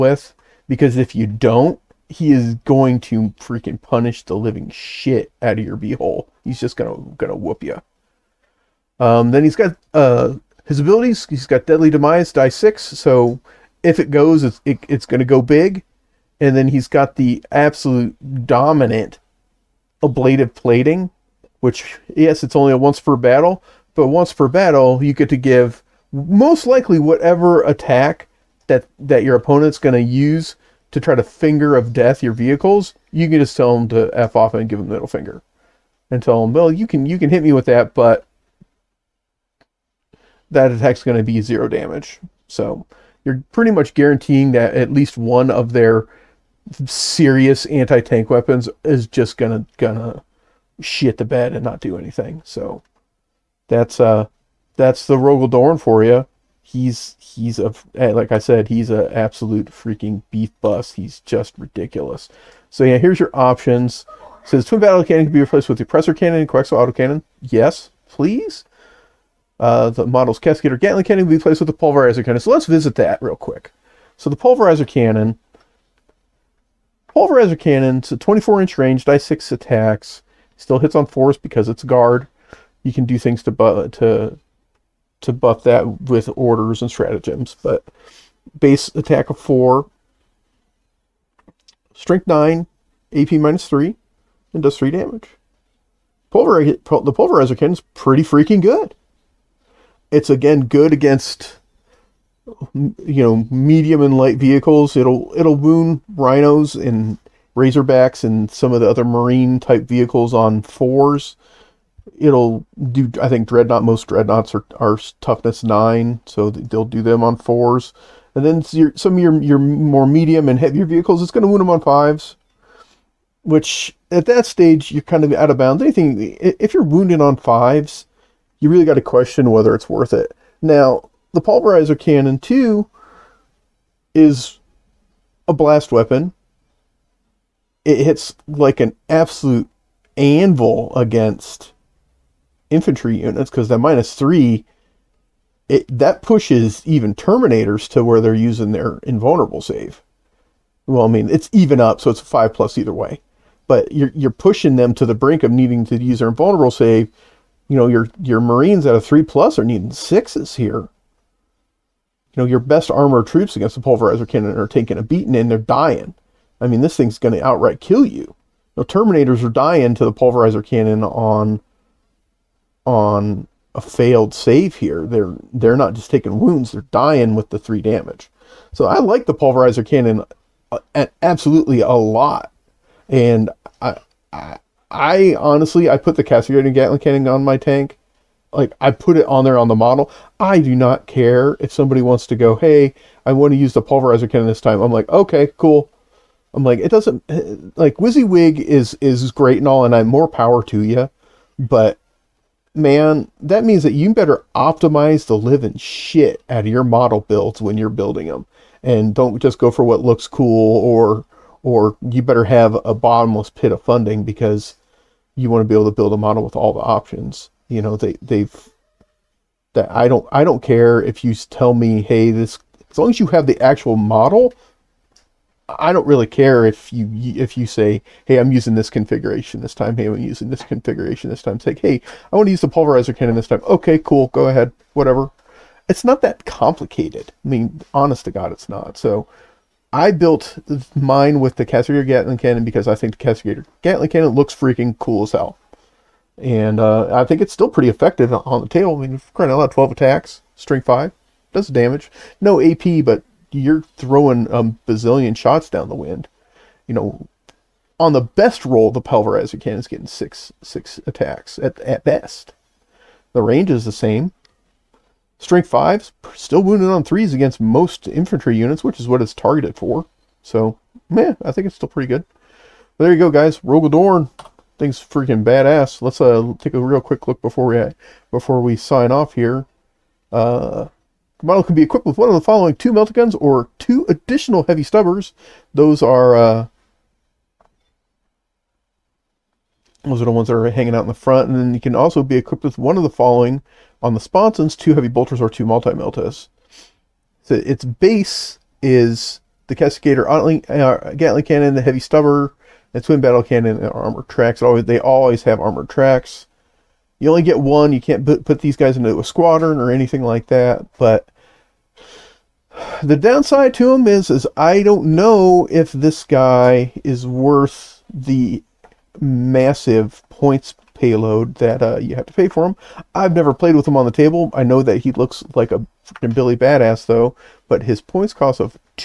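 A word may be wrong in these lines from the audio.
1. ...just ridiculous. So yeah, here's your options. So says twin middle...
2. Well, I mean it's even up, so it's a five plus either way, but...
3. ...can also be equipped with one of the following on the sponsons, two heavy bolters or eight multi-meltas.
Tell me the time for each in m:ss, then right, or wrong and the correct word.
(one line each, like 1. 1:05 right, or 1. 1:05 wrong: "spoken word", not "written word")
1. 1:01 wrong: "battle", not "middle"
2. 2:30 right
3. 4:51 wrong: "two", not "eight".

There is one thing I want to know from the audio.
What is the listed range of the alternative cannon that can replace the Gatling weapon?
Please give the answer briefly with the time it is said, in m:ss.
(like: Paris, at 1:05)
24 inches, at 1:18.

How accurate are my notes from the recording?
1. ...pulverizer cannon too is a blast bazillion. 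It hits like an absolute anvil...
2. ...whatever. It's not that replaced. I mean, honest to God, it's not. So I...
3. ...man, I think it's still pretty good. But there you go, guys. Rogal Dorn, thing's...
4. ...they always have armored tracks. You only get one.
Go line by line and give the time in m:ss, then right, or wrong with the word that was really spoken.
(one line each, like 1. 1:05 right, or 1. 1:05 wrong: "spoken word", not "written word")
1. 2:11 wrong: "weapon", not "bazillion"
2. 3:54 wrong: "complicated", not "replaced"
3. 4:31 right
4. 5:04 right.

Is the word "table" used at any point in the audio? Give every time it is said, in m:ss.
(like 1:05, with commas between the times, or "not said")
4:08, 5:24.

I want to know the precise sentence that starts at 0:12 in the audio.
So if it goes, it's it, it's gonna go big.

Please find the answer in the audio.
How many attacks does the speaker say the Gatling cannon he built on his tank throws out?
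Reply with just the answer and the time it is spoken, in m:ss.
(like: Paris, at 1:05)
12, at 4:09.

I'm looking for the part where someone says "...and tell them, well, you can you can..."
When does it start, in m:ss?
0:36.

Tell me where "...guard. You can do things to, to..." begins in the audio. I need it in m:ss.
1:21.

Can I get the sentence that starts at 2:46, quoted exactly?
I mean this thing's going to outright kill you.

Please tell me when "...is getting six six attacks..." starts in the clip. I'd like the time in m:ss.
4:19.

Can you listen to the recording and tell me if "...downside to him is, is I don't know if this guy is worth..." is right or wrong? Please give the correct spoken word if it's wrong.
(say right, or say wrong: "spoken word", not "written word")
right.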